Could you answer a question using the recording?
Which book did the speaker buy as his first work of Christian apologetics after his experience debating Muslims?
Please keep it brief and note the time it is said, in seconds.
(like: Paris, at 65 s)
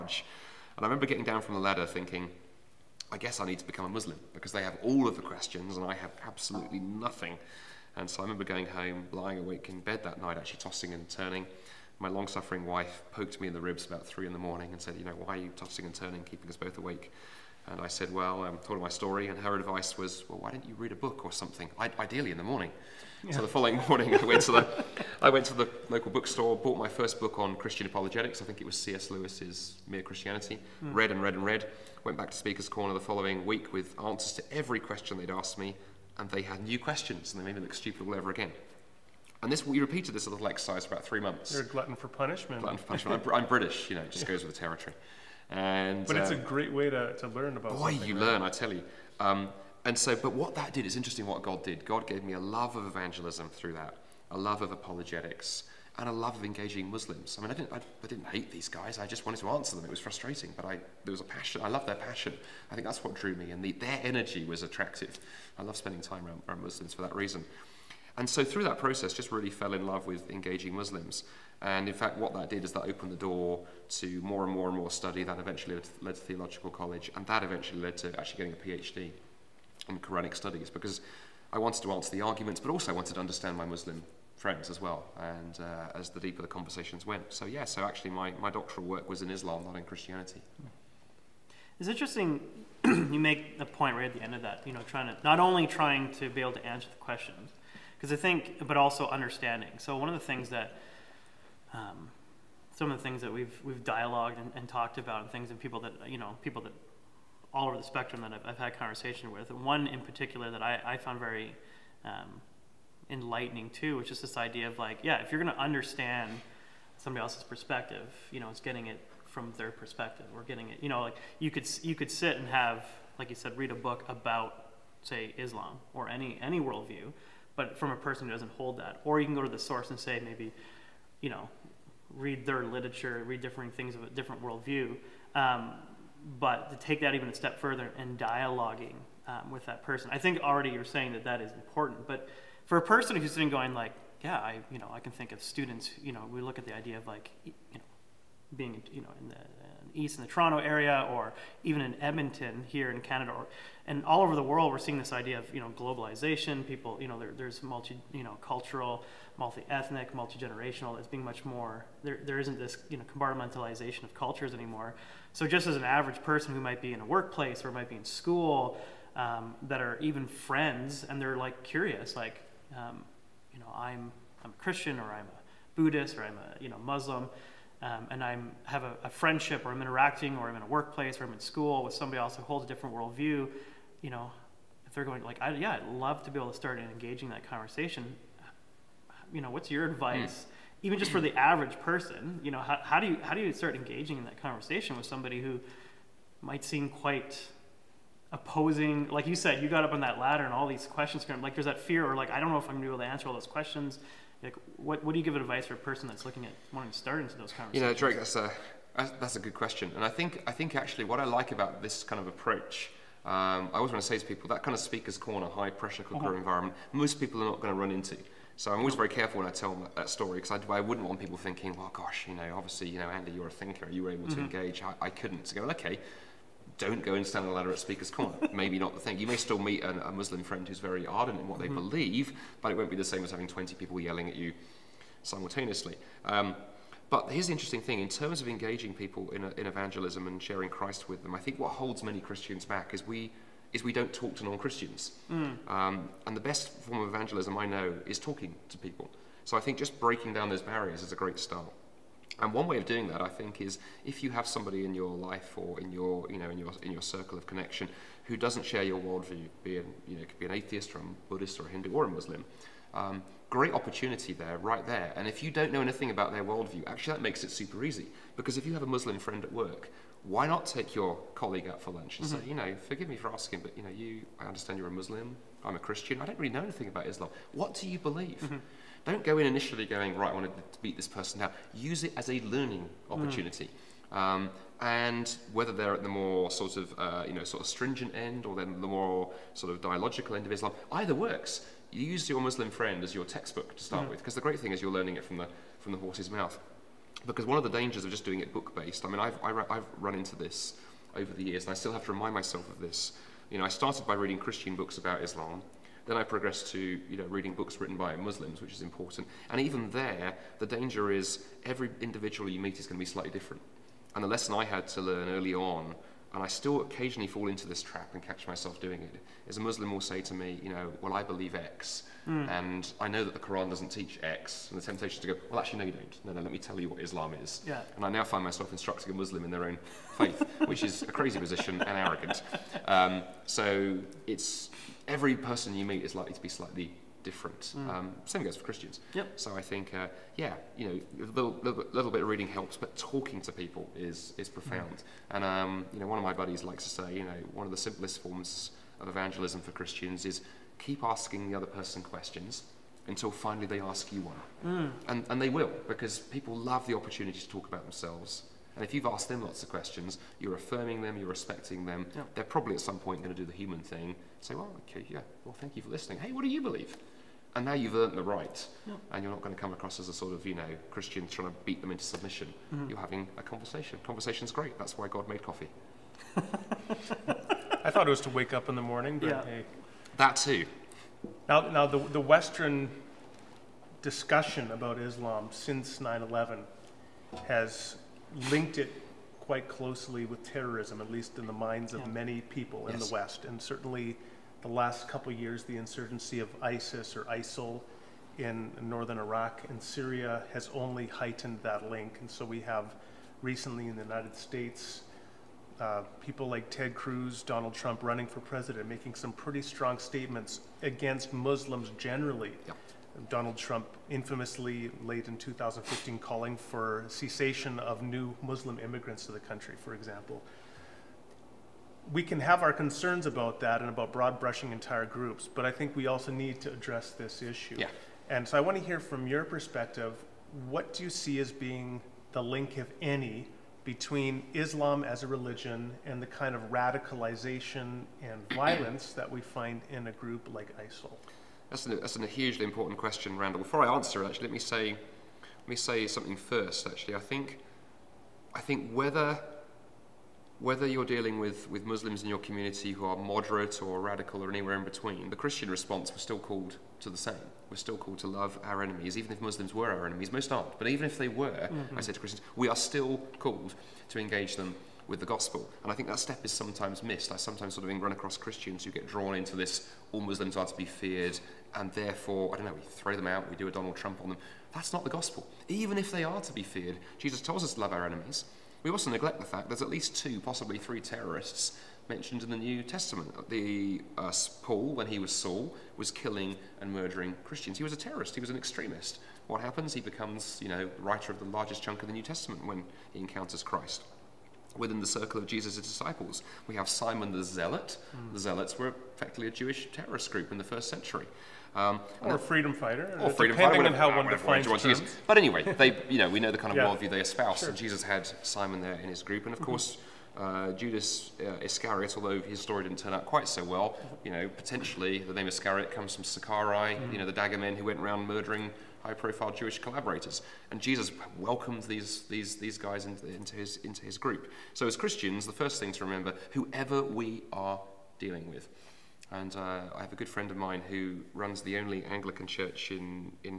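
Mere Christianity, at 29 s.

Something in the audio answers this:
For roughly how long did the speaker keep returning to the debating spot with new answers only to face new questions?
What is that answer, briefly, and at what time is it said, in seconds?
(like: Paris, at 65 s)
about three months, at 40 s.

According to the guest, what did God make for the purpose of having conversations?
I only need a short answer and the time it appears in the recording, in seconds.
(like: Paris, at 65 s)
coffee, at 375 s.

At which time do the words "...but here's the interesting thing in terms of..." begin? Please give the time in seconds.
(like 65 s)
237 s.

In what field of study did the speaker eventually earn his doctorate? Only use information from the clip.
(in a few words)
Quranic studies.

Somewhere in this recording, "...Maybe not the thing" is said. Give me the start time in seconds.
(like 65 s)
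228 s.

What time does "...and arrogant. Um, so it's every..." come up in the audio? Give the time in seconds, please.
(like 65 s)
331 s.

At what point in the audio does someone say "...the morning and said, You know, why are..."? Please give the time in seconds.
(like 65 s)
14 s.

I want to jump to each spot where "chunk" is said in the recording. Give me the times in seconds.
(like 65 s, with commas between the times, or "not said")
491 s.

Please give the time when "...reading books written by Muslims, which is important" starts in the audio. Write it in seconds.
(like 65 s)
307 s.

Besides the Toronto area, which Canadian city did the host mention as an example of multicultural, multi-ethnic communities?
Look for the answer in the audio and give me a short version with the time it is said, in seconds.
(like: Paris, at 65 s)
Edmonton, at 151 s.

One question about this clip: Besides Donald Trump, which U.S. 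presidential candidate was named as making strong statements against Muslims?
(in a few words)
Ted Cruz.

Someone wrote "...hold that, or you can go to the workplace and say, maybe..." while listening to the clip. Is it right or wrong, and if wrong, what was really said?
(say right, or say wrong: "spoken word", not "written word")
wrong: "source", not "workplace".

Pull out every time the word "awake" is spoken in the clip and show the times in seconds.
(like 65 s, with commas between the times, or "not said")
9 s, 16 s.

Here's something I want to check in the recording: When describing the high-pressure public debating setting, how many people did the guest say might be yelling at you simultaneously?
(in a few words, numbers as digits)
20.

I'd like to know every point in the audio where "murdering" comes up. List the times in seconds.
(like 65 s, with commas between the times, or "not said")
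486 s, 518 s.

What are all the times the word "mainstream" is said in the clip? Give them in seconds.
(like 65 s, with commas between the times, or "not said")
not said.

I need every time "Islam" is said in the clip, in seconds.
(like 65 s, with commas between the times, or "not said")
89 s, 125 s, 277 s, 290 s, 305 s, 327 s, 384 s, 434 s.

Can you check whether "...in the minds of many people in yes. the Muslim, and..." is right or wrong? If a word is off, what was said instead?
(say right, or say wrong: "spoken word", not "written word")
wrong: "West", not "Muslim".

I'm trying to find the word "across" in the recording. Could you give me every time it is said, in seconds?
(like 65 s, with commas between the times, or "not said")
369 s, 468 s.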